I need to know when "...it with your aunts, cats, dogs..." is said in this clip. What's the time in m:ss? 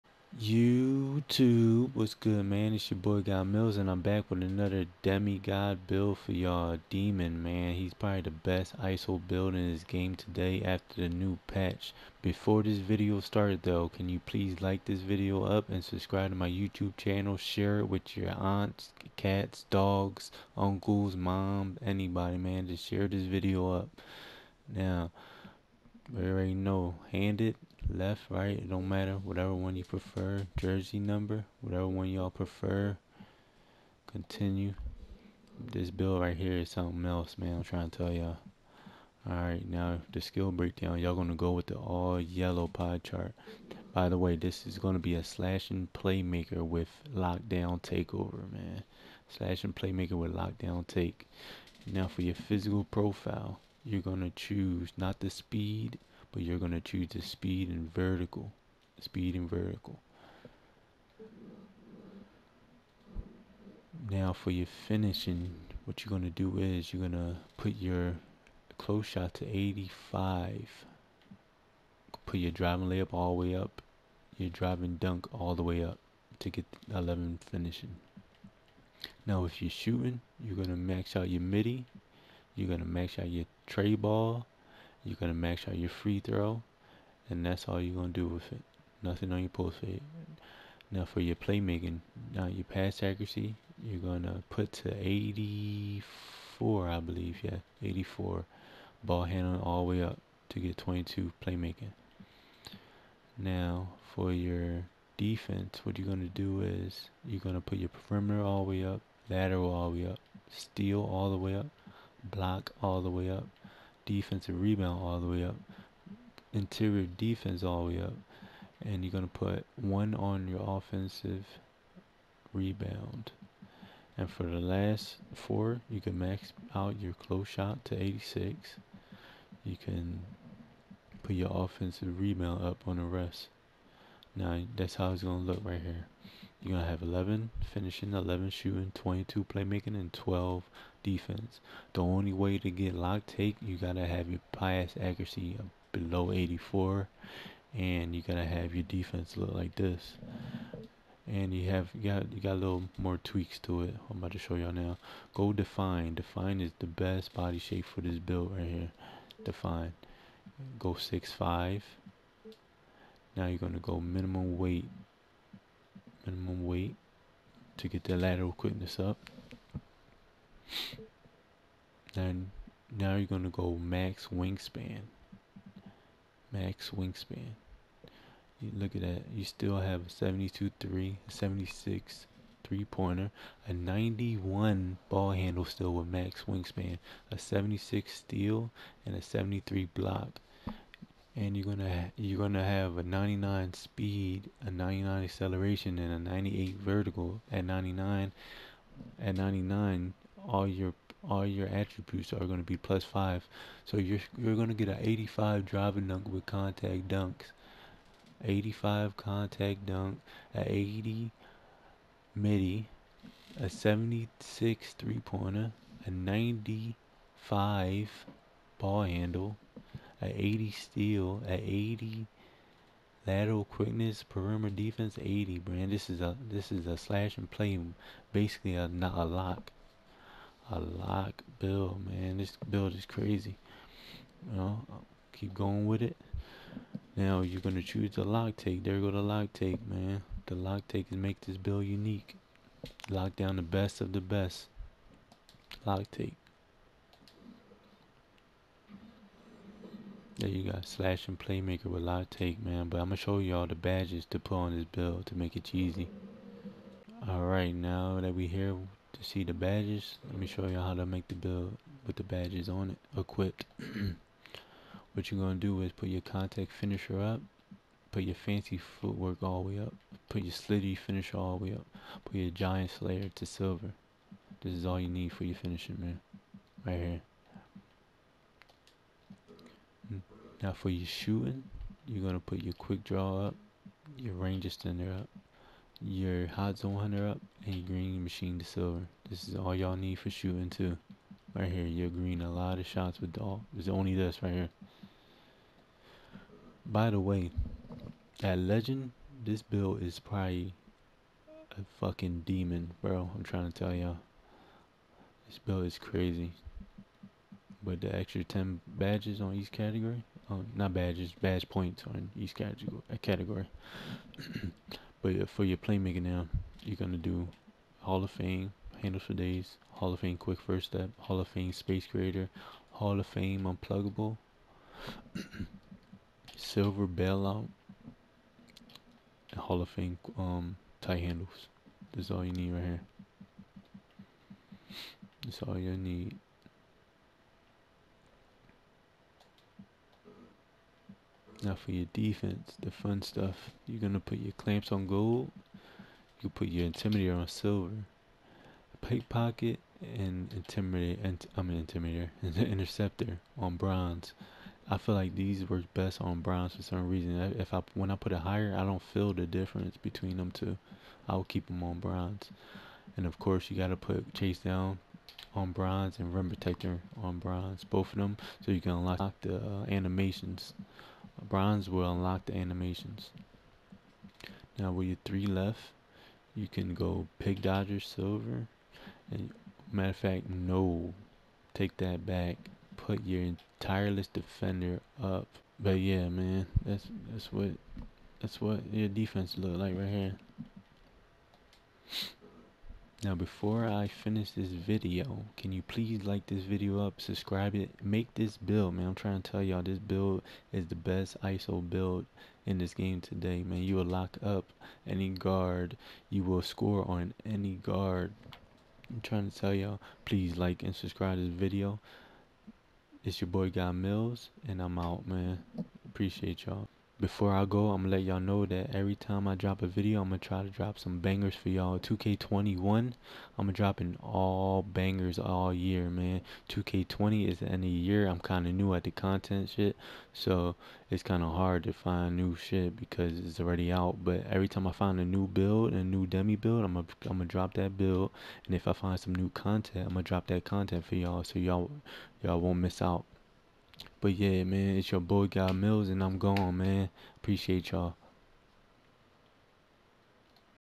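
0:17.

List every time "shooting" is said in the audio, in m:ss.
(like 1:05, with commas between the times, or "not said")
1:19, 2:18, 4:41, 4:50.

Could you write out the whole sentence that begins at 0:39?
Alright, now the skill breakdown, y'all gonna go with the all yellow pie chart.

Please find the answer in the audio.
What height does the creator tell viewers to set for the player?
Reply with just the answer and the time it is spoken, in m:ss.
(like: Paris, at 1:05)
6'5", at 2:40.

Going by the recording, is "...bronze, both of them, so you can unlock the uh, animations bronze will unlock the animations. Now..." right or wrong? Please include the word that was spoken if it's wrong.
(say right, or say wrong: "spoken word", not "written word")
right.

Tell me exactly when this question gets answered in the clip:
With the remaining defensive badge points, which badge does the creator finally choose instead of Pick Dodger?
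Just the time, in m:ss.
6:23.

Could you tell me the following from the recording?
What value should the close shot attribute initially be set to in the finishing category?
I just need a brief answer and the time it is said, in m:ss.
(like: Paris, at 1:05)
85, at 1:07.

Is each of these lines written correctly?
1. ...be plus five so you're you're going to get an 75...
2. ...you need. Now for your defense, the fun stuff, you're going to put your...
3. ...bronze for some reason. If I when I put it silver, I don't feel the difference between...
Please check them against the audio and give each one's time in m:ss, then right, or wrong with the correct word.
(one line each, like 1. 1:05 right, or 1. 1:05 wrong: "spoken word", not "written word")
1. 3:22 wrong: "85", not "75"
2. 5:35 right
3. 5:56 wrong: "higher", not "silver".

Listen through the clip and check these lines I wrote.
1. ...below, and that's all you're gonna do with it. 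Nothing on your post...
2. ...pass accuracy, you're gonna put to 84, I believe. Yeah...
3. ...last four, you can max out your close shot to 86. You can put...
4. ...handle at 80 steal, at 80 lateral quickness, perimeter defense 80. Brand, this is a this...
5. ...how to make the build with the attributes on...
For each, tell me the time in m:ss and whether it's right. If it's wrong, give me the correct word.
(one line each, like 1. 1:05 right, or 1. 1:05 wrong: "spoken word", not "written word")
1. 1:26 wrong: "throw", not "below"
2. 1:32 right
3. 2:04 right
4. 3:39 right
5. 4:20 wrong: "badges", not "attributes".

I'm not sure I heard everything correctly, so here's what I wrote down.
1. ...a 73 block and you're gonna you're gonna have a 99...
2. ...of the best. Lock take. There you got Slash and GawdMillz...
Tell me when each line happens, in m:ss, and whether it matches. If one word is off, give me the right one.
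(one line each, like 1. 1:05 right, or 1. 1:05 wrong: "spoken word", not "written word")
1. 3:09 right
2. 4:04 wrong: "Playmaker", not "GawdMillz".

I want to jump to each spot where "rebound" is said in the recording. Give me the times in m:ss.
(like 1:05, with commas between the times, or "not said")
1:54, 2:02, 2:12.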